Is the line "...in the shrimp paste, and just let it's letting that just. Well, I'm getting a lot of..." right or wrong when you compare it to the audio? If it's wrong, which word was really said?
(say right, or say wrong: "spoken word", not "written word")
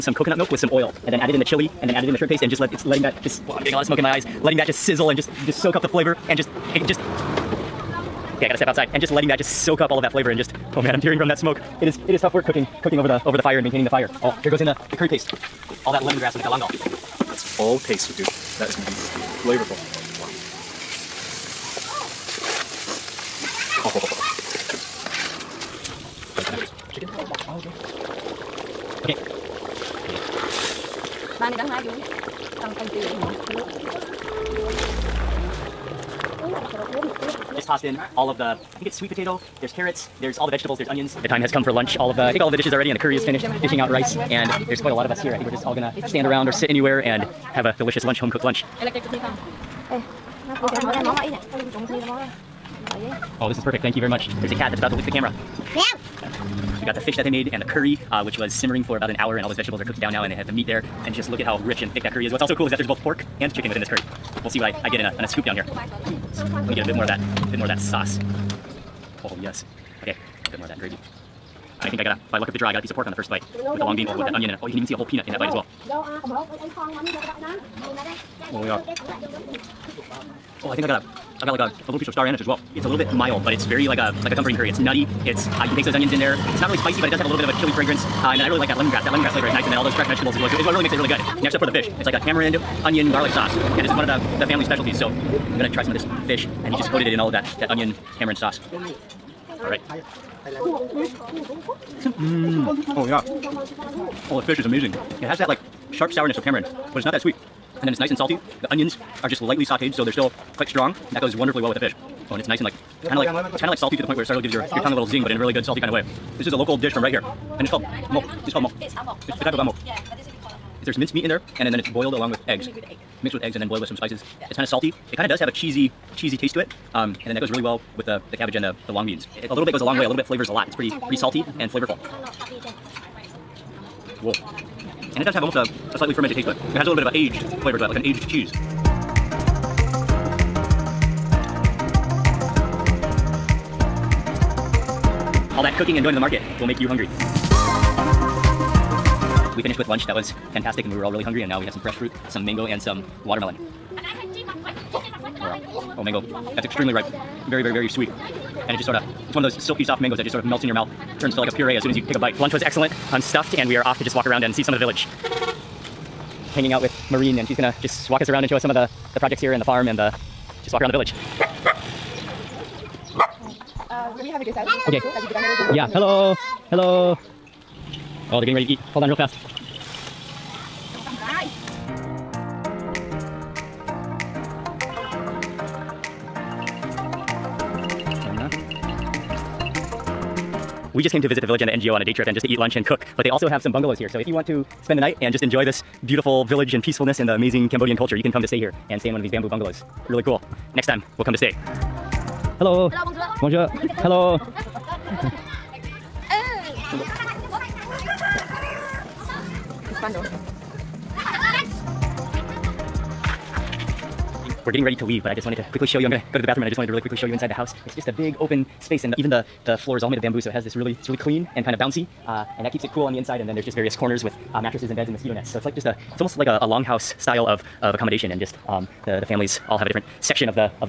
right.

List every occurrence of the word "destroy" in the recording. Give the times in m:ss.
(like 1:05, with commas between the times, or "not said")
not said.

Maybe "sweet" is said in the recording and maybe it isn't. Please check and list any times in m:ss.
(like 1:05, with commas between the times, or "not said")
0:38, 1:47, 2:37.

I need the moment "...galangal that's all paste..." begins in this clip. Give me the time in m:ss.
0:16.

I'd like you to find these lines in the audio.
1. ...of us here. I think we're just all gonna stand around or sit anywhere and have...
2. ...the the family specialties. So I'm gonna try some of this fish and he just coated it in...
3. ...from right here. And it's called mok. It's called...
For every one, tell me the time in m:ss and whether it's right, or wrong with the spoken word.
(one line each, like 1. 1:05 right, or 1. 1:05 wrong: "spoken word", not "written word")
1. 0:45 right
2. 1:34 right
3. 1:56 right.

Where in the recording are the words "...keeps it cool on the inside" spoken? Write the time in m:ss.
3:42.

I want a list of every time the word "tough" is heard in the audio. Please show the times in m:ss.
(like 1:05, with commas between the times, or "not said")
0:12.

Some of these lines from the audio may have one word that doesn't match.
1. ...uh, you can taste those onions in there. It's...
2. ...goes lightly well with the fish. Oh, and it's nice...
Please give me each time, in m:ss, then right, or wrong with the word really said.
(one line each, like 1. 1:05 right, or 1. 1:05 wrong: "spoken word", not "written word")
1. 1:25 right
2. 1:51 wrong: "wonderfully", not "lightly".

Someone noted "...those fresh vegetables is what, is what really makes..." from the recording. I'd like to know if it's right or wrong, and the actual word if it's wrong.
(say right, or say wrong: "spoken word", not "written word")
right.